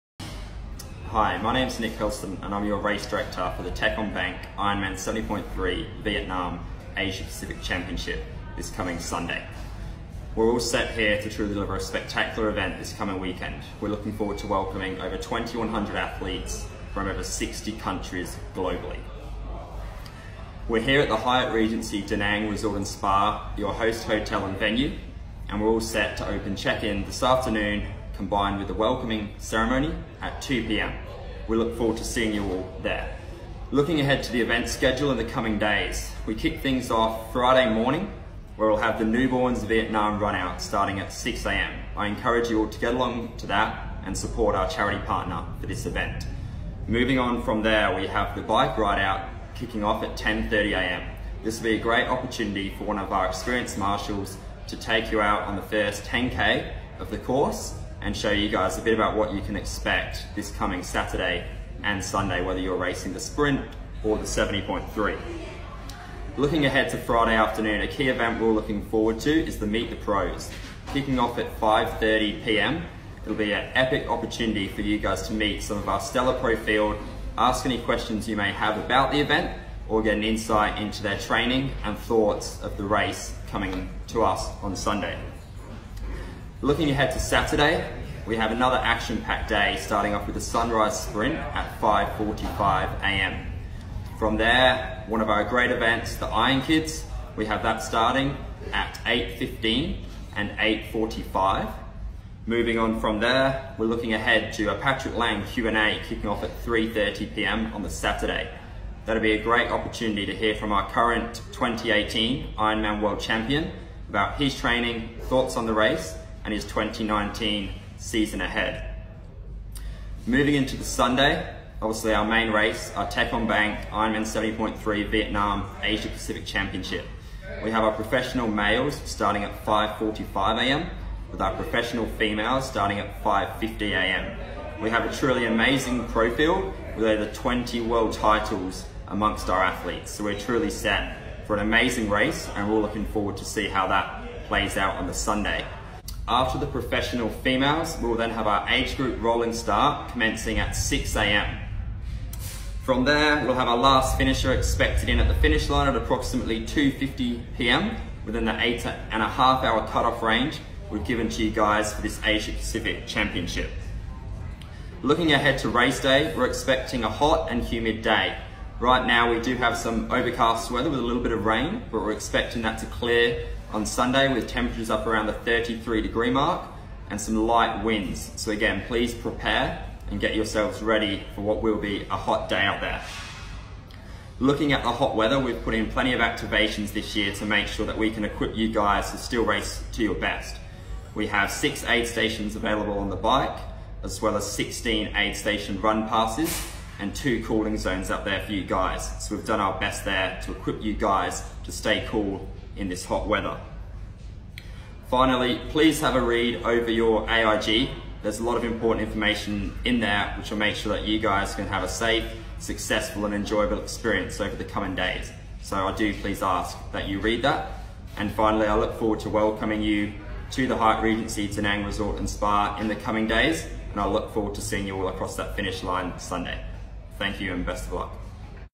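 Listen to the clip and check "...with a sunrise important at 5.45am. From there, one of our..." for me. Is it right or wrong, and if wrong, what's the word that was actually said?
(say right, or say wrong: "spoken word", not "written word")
wrong: "sprint", not "important".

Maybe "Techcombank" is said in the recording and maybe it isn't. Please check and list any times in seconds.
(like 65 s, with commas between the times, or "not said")
3 s, 123 s.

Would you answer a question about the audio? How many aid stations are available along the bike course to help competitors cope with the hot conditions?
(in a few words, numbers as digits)
6.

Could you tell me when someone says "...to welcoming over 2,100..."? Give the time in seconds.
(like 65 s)
14 s.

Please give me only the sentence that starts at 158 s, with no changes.
within the eight and a half hour cutoff range we've given to you guys for this Asia Pacific Championship.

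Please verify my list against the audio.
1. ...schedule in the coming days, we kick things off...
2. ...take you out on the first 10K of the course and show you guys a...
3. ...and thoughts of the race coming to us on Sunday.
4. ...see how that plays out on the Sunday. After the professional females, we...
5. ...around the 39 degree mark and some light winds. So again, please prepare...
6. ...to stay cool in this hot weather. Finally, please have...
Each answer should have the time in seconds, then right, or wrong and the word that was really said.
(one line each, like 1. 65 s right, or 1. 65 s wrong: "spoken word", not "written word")
1. 34 s right
2. 54 s right
3. 81 s right
4. 143 s right
5. 175 s wrong: "33", not "39"
6. 201 s right.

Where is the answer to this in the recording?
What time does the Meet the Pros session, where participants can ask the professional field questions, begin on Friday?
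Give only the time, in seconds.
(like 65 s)
71 s.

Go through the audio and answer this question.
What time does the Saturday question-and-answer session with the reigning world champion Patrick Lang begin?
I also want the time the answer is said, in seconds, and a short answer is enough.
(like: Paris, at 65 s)
3:30 p.m., at 106 s.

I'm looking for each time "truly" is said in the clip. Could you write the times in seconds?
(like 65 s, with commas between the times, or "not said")
11 s, 135 s, 140 s.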